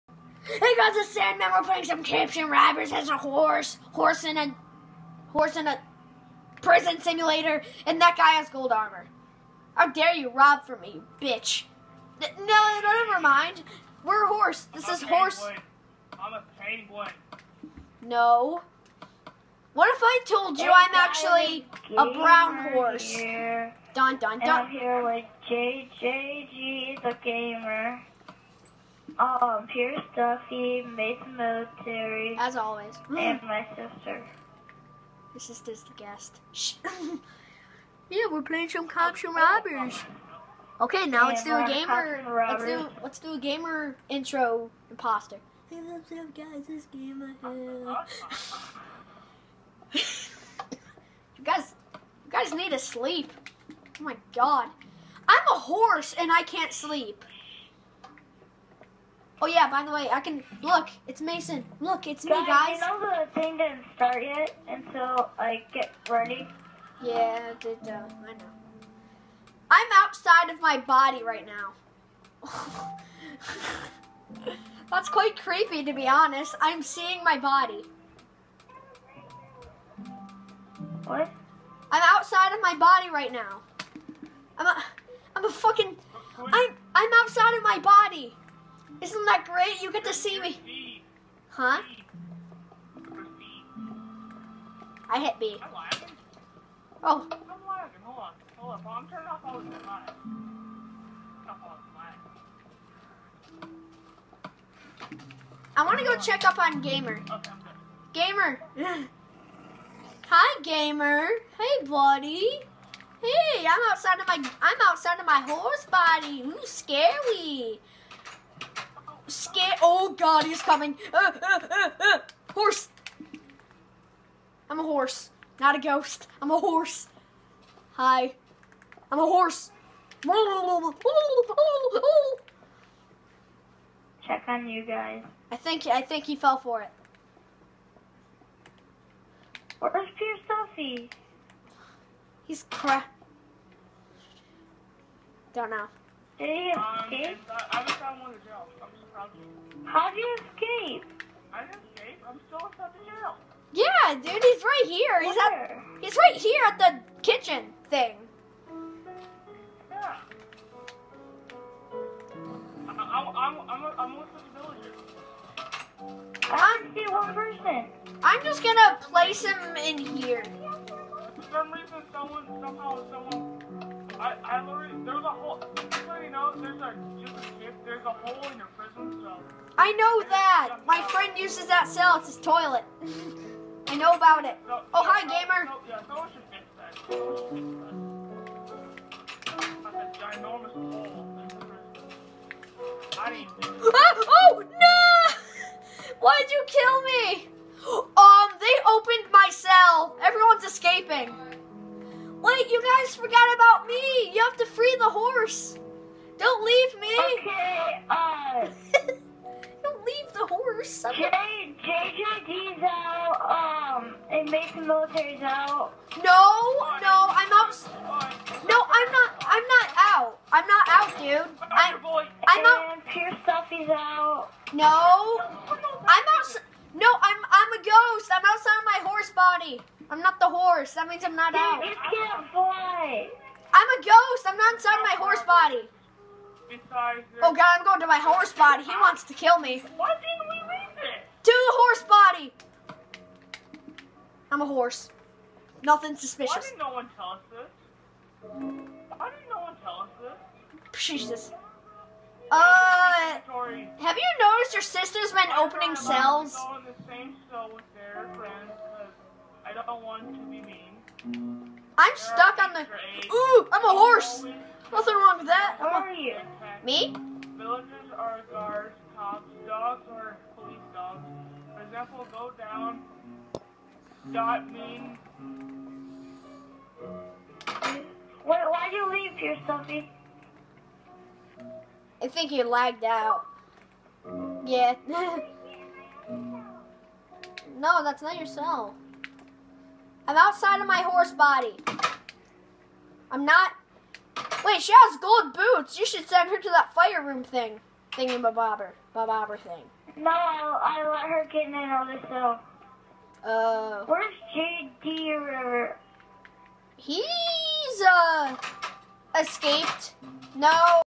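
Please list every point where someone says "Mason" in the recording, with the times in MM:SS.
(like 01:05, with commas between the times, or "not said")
00:30, 01:01, 03:34.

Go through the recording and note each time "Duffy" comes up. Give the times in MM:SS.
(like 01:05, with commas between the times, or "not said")
00:30, 02:20, 03:43.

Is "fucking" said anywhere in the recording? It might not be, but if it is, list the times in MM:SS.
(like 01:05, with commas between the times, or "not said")
01:25.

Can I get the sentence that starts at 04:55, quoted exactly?
You should send her to that fire room thing.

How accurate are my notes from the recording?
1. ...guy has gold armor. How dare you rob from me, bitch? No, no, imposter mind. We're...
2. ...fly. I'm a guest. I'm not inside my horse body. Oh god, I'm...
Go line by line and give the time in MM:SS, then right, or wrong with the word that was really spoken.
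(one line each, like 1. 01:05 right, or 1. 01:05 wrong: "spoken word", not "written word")
1. 00:08 wrong: "never", not "imposter"
2. 03:52 wrong: "ghost", not "guest".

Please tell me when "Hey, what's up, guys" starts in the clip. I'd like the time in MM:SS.
00:45.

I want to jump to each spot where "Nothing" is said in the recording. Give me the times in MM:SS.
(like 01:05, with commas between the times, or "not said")
04:05, 04:24.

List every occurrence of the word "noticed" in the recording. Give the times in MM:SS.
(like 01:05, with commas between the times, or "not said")
04:14.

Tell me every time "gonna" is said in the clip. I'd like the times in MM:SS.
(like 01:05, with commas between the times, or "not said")
02:48.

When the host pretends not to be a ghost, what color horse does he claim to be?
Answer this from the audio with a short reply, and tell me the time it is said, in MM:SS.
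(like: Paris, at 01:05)
Brown, at 00:22.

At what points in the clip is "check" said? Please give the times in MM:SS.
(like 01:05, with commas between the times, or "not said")
01:46, 02:10.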